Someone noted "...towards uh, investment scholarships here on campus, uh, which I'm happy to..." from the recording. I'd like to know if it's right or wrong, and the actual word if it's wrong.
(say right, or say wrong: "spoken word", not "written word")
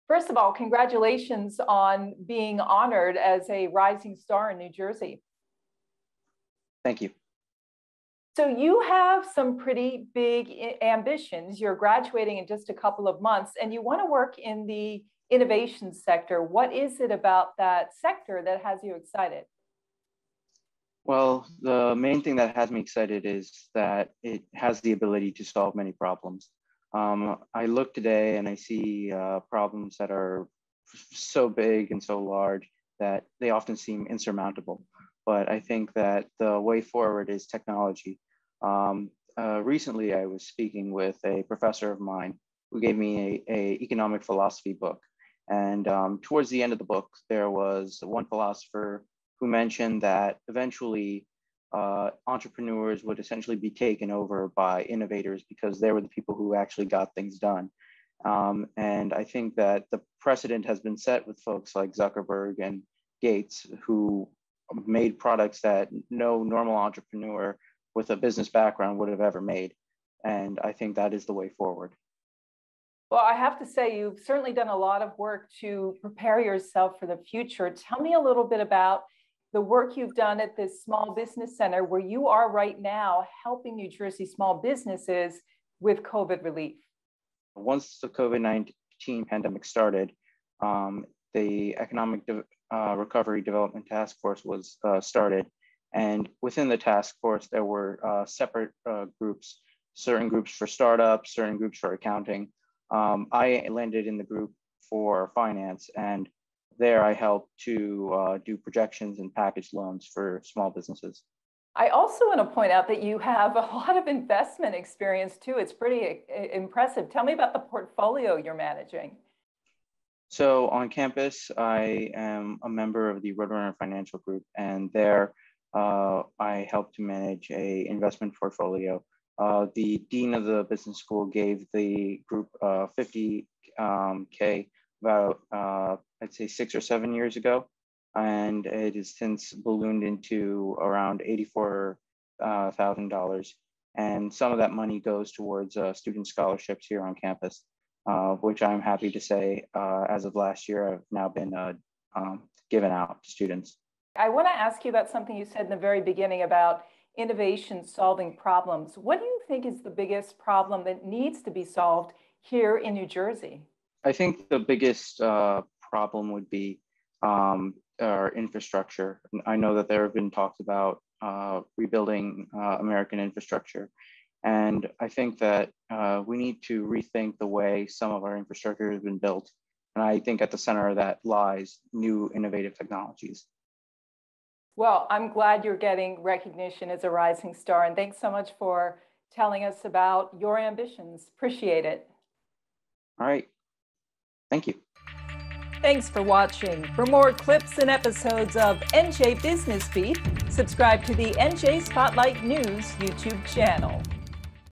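wrong: "student", not "investment".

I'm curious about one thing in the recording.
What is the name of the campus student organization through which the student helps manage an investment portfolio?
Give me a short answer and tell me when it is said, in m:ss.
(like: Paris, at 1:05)
Roadrunner Financial Group, at 2:03.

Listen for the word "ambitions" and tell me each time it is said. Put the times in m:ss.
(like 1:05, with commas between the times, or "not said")
0:10, 3:10.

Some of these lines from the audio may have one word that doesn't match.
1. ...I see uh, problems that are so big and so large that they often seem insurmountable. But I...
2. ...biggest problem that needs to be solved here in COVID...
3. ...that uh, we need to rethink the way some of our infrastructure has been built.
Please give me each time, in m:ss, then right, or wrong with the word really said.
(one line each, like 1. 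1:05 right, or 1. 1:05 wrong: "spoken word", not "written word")
1. 0:28 right
2. 2:39 wrong: "New", not "COVID"
3. 2:55 right.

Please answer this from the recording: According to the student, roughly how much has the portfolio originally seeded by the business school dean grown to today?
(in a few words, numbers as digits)
$84,000.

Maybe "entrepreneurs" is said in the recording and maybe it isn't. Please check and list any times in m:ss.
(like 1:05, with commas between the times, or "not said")
0:52, 1:06.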